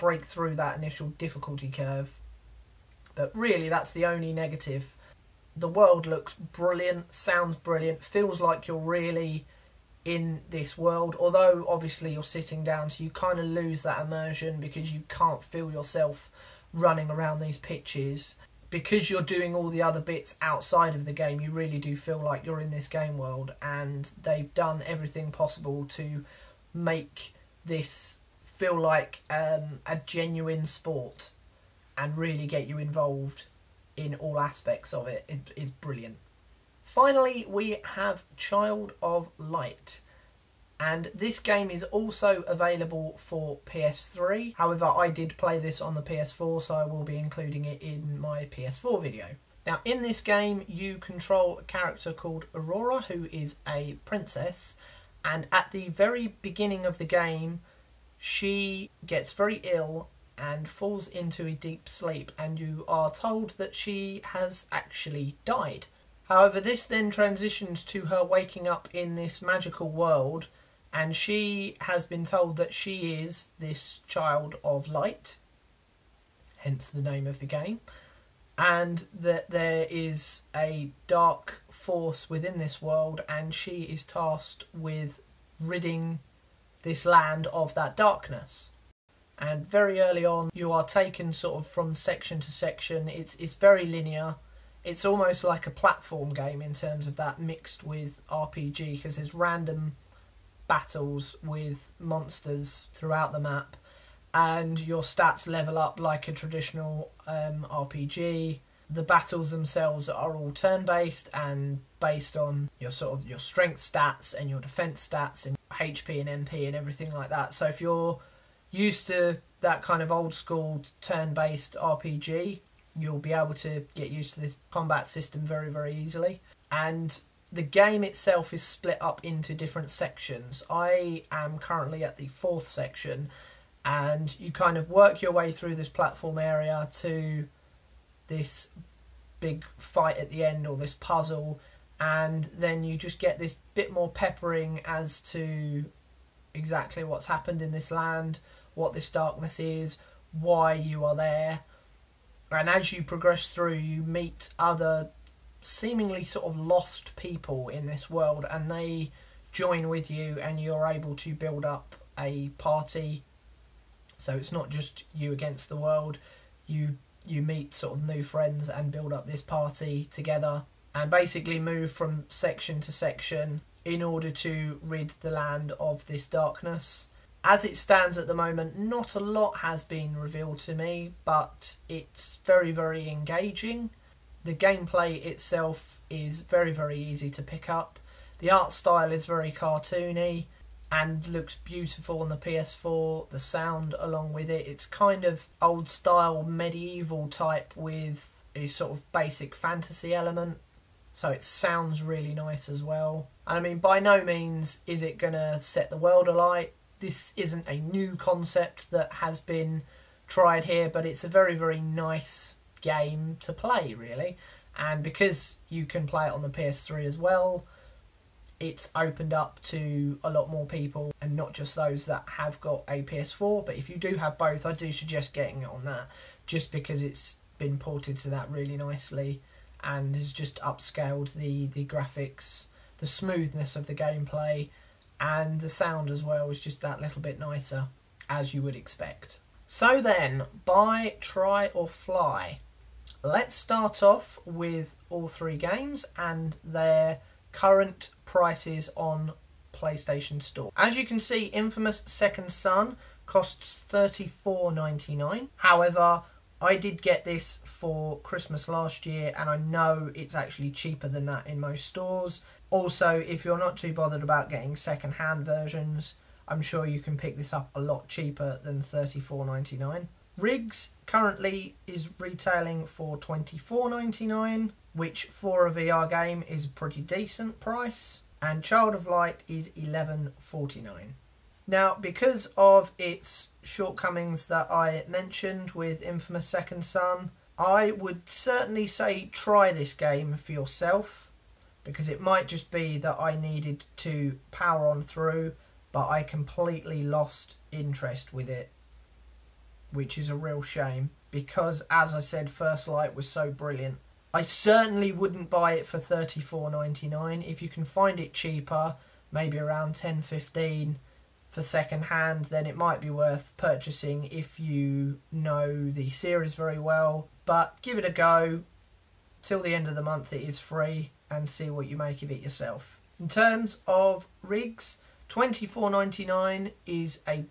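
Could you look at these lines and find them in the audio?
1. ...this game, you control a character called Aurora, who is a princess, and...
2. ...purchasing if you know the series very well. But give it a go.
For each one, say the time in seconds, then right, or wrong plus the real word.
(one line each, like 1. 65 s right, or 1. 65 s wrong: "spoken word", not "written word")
1. 50 s right
2. 313 s right.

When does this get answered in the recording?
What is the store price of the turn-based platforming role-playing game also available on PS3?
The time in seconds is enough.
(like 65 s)
279 s.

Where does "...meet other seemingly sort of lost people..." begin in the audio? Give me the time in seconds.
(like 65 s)
154 s.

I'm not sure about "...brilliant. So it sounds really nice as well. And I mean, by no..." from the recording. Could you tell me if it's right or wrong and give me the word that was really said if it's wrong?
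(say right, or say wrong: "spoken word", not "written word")
wrong: "element", not "brilliant".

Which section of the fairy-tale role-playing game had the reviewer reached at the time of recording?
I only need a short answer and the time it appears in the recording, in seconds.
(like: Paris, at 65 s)
fourth section, at 132 s.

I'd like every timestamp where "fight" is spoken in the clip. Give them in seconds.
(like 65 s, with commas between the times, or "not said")
139 s.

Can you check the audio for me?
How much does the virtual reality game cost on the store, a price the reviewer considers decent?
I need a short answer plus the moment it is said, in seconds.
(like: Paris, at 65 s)
$24.99, at 273 s.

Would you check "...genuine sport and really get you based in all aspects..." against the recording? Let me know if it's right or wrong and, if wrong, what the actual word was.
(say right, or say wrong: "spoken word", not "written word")
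wrong: "involved", not "based".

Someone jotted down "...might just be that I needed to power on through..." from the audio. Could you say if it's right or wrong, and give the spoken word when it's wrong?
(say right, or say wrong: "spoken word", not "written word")
right.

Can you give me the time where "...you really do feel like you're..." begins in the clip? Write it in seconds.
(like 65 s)
21 s.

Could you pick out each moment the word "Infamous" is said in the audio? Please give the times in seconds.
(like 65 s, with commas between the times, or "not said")
251 s, 286 s.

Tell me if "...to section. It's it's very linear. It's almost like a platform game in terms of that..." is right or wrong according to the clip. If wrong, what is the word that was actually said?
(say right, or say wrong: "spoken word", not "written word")
right.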